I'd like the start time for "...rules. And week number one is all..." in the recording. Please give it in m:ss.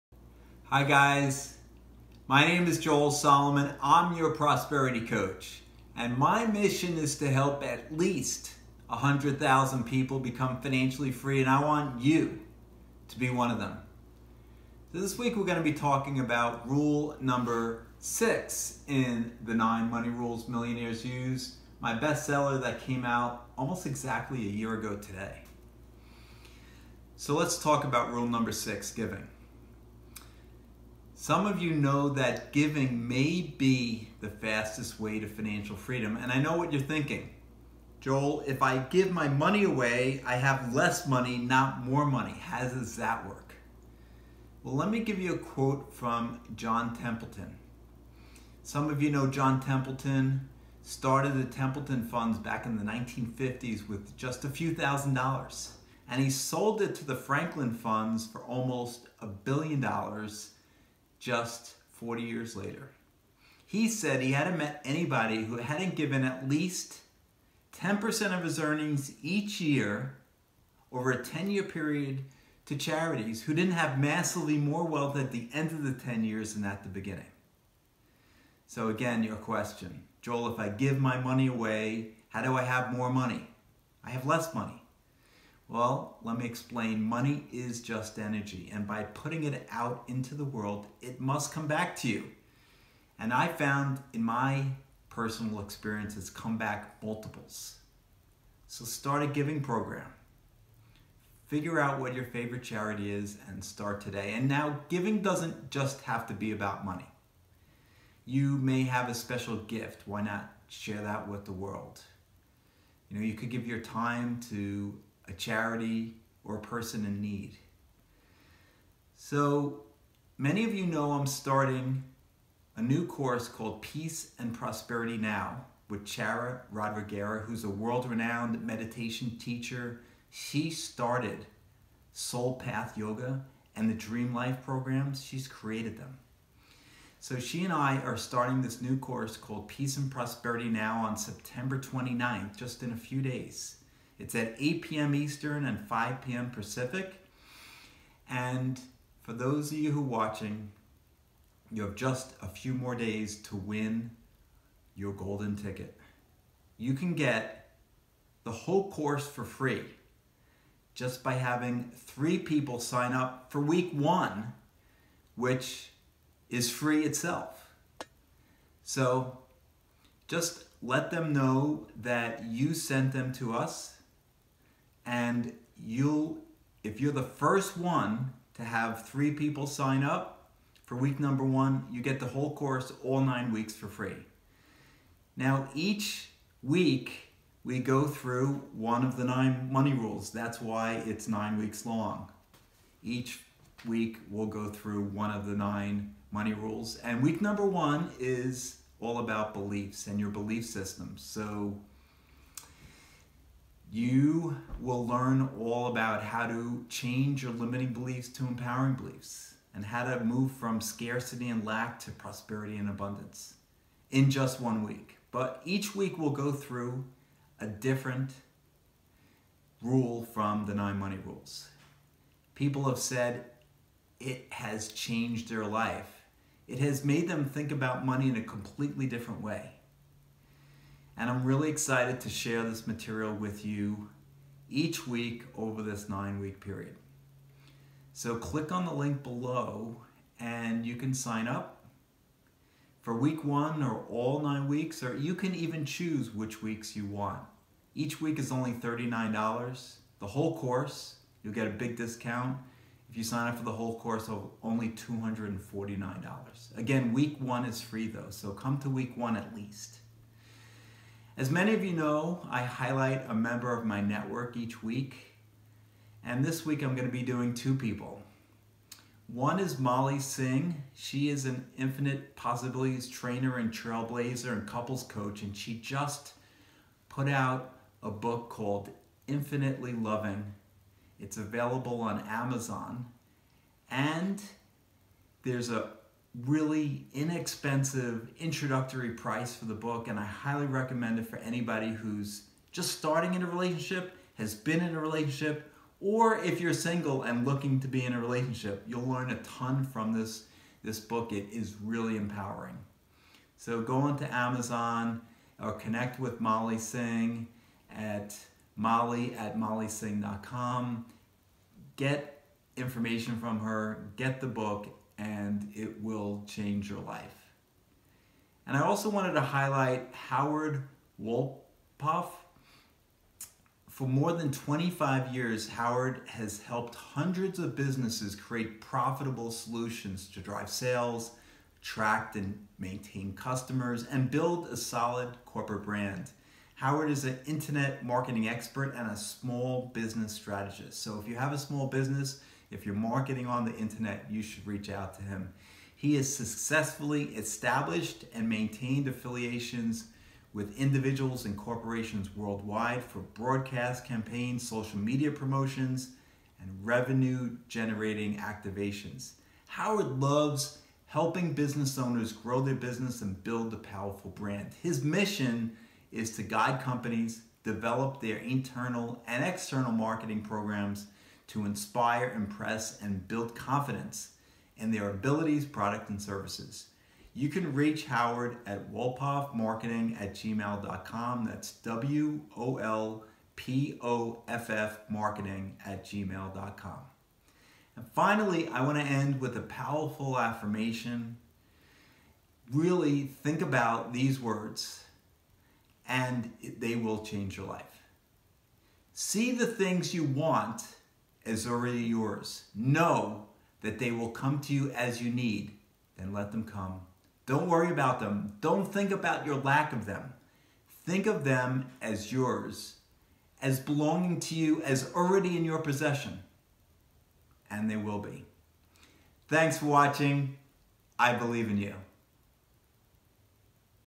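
3:16.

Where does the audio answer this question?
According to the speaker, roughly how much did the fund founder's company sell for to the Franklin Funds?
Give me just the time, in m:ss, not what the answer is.
0:58.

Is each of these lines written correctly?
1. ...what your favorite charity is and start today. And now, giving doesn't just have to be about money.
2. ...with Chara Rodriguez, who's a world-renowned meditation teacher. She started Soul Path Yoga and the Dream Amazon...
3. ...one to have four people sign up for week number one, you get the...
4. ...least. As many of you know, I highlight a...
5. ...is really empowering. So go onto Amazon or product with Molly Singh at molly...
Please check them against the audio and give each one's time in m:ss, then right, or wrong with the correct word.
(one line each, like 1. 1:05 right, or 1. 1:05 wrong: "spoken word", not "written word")
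1. 1:42 right
2. 2:05 wrong: "Life", not "Amazon"
3. 2:57 wrong: "three", not "four"
4. 4:19 right
5. 5:01 wrong: "connect", not "product".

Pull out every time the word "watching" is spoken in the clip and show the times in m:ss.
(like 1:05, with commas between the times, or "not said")
2:30, 6:59.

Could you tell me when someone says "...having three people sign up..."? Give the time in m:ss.
2:41.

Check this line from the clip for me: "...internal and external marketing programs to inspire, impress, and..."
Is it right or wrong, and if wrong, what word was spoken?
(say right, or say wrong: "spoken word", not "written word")
right.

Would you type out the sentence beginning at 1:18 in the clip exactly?
So, again, your question Joel, if I give my money away, how do I have more money?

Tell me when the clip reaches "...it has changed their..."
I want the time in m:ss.
3:44.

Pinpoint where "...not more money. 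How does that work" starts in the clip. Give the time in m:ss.
0:41.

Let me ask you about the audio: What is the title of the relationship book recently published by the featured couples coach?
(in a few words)
Infinitely Loving.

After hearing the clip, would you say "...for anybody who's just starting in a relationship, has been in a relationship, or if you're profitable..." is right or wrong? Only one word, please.
wrong.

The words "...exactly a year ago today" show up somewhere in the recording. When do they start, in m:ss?
0:23.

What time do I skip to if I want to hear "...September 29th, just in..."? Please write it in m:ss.
2:21.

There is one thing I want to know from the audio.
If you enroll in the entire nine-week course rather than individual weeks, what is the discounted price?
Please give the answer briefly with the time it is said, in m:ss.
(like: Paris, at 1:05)
$249, at 4:14.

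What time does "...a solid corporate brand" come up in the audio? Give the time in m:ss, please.
5:34.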